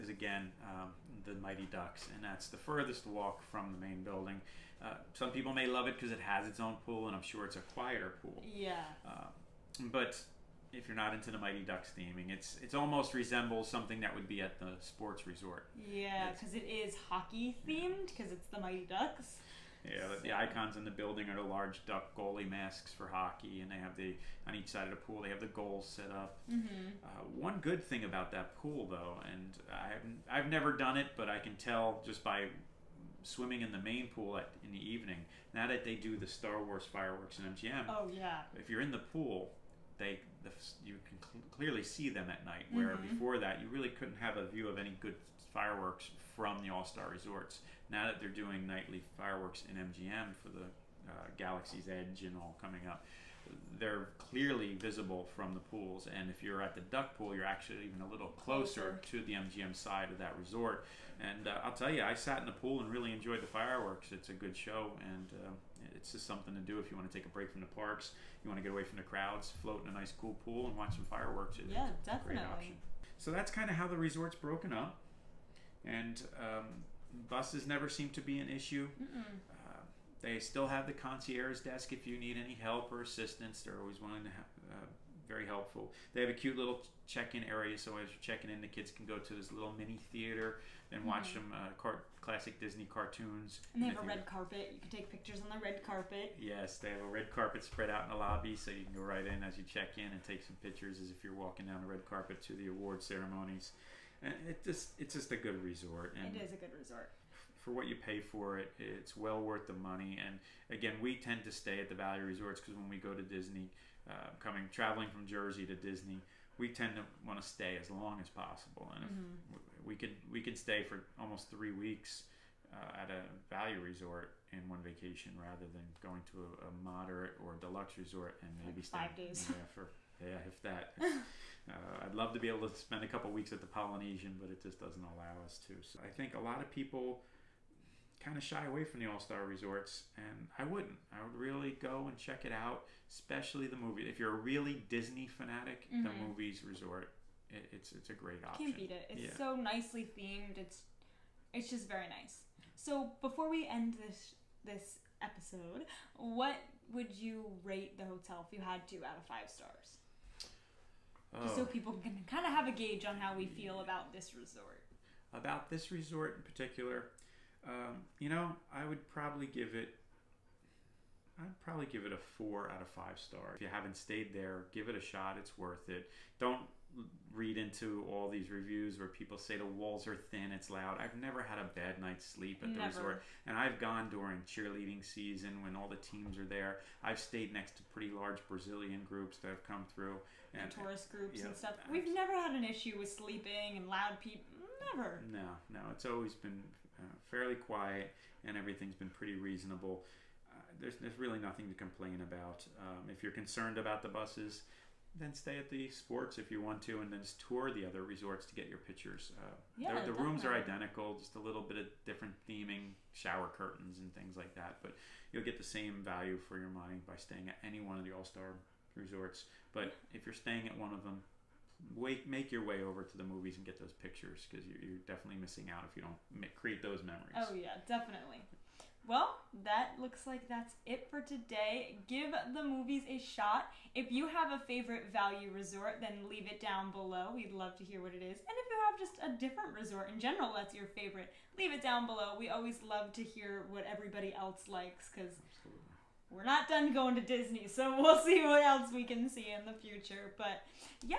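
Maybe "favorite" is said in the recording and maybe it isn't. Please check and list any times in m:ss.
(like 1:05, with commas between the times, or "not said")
3:54, 4:00.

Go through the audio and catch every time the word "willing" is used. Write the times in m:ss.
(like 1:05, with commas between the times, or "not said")
1:24.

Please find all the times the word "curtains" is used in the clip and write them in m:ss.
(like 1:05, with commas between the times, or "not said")
3:33.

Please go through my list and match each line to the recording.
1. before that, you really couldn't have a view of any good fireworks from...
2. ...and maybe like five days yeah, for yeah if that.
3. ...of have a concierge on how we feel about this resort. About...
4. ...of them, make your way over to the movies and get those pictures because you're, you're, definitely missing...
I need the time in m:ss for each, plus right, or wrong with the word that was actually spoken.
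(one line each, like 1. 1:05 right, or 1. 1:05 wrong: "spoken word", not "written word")
1. 0:43 right
2. 2:08 right
3. 2:42 wrong: "gauge", not "concierge"
4. 3:40 right.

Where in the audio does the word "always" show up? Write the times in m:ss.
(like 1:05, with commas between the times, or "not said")
1:23, 3:16, 4:02.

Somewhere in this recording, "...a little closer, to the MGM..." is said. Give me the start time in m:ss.
0:58.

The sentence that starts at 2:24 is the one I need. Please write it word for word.
If you're a really Disney fanatic, mm-hmm.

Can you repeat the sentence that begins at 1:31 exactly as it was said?
some uh, cart- classic Disney cartoons.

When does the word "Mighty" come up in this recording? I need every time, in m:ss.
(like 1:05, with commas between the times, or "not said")
0:01, 0:11, 0:18.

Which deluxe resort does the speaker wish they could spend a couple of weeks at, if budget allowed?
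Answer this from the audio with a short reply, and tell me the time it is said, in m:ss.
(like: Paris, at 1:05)
Polynesian, at 2:13.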